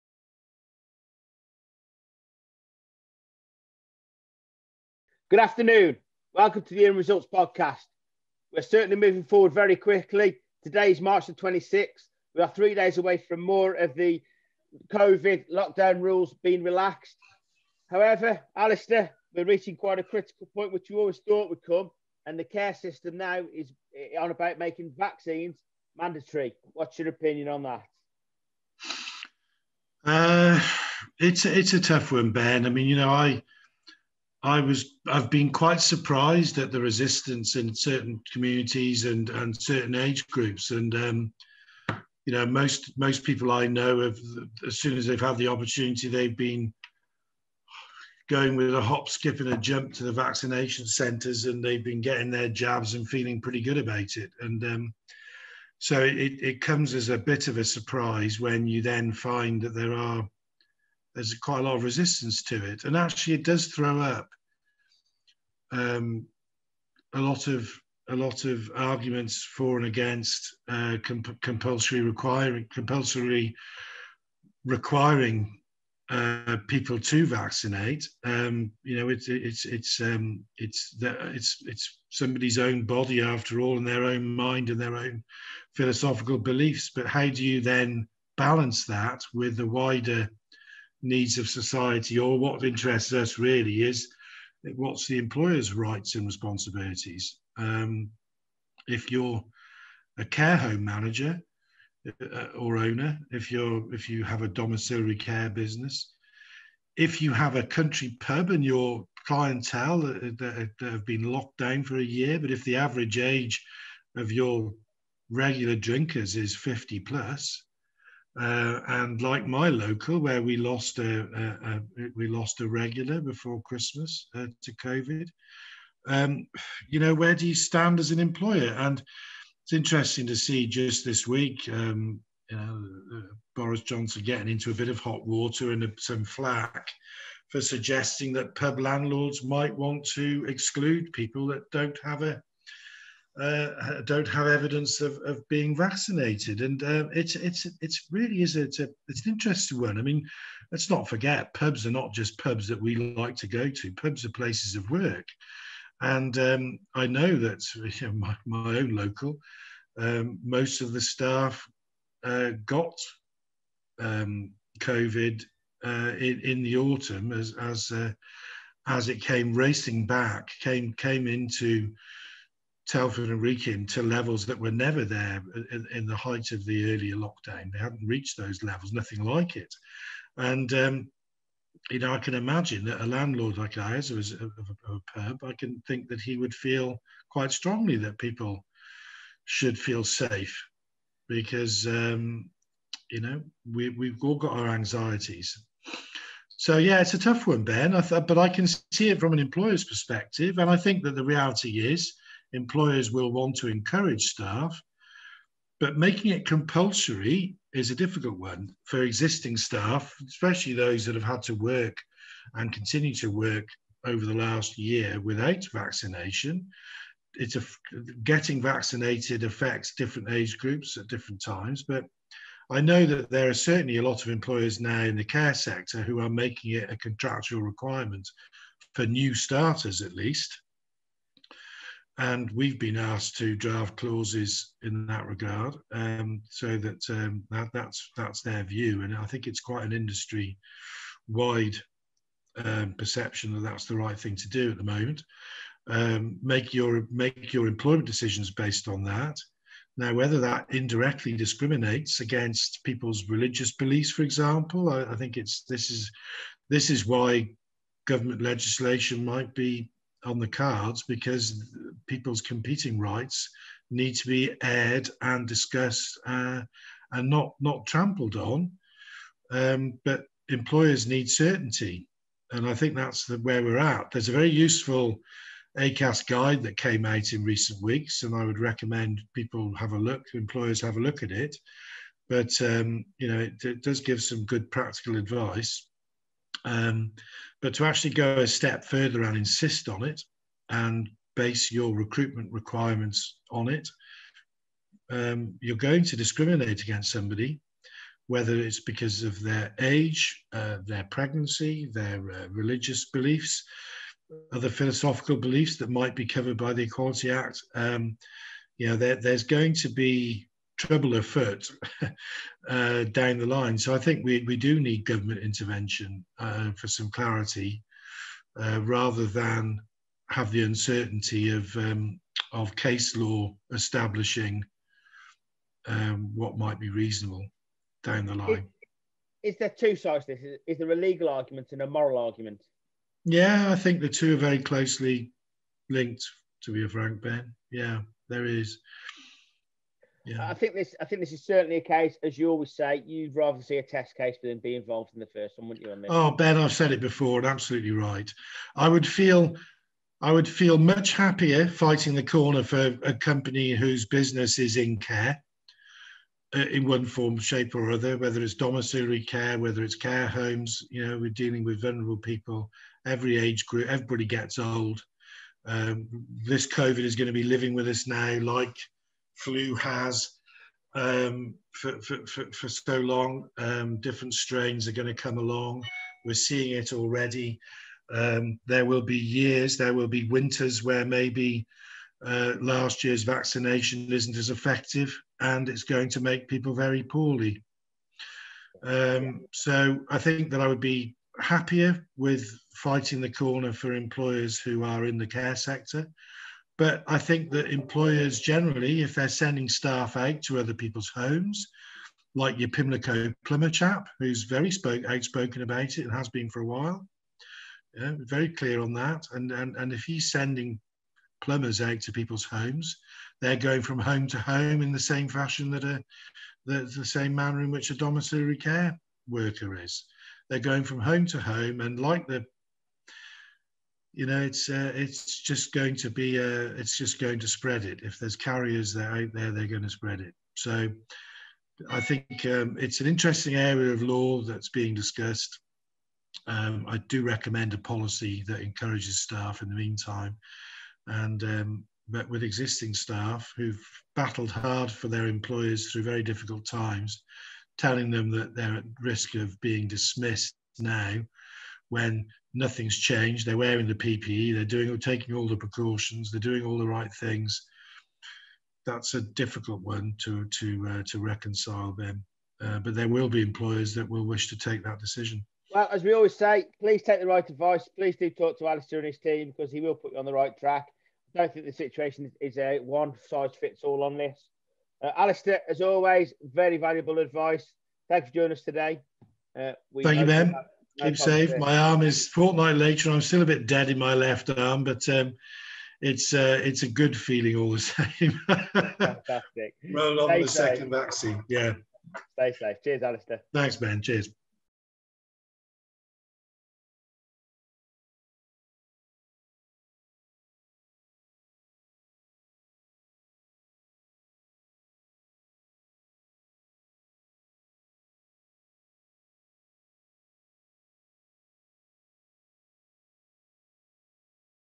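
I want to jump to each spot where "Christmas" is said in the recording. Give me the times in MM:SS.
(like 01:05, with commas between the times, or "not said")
02:03.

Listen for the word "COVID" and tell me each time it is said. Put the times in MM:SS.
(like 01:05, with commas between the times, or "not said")
00:14, 02:04, 02:44, 06:06.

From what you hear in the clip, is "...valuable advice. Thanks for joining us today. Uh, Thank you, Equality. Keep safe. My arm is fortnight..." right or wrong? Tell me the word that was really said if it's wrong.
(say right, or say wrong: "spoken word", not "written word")
wrong: "Ben", not "Equality".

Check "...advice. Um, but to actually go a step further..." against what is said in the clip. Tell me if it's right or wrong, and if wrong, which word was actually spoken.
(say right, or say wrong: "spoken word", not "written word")
right.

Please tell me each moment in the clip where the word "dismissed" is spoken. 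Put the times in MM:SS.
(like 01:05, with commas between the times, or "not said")
07:29.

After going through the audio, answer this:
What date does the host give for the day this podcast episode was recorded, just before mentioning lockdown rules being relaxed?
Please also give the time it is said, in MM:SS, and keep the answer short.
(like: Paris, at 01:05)
March 26th, at 00:10.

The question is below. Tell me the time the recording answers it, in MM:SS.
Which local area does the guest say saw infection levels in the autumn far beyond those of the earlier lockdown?
02:52.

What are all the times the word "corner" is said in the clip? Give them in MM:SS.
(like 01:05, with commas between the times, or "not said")
05:52, 06:33.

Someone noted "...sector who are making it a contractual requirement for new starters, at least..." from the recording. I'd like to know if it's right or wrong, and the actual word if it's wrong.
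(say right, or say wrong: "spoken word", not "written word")
right.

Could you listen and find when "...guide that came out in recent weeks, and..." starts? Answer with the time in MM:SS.
04:36.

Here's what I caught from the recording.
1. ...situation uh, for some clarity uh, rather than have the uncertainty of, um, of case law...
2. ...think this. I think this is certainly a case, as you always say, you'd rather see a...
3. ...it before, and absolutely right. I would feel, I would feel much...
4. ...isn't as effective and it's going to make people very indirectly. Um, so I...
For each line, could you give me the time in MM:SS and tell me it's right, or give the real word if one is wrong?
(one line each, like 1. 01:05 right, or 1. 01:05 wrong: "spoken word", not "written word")
1. 05:15 wrong: "intervention", not "situation"
2. 05:40 right
3. 05:46 right
4. 06:24 wrong: "poorly", not "indirectly".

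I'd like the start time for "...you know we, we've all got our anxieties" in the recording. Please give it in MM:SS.
03:13.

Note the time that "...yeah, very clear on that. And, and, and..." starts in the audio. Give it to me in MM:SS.
06:47.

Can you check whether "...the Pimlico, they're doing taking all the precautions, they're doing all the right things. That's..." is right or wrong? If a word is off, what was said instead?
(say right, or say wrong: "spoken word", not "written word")
wrong: "PPE", not "Pimlico".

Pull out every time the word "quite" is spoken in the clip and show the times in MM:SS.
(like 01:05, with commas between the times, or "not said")
00:19, 00:35, 01:01, 03:07, 03:59.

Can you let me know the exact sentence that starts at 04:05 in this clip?
Um, make your make your employment decisions based on that.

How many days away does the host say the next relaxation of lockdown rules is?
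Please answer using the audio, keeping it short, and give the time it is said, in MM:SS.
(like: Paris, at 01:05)
3, at 00:12.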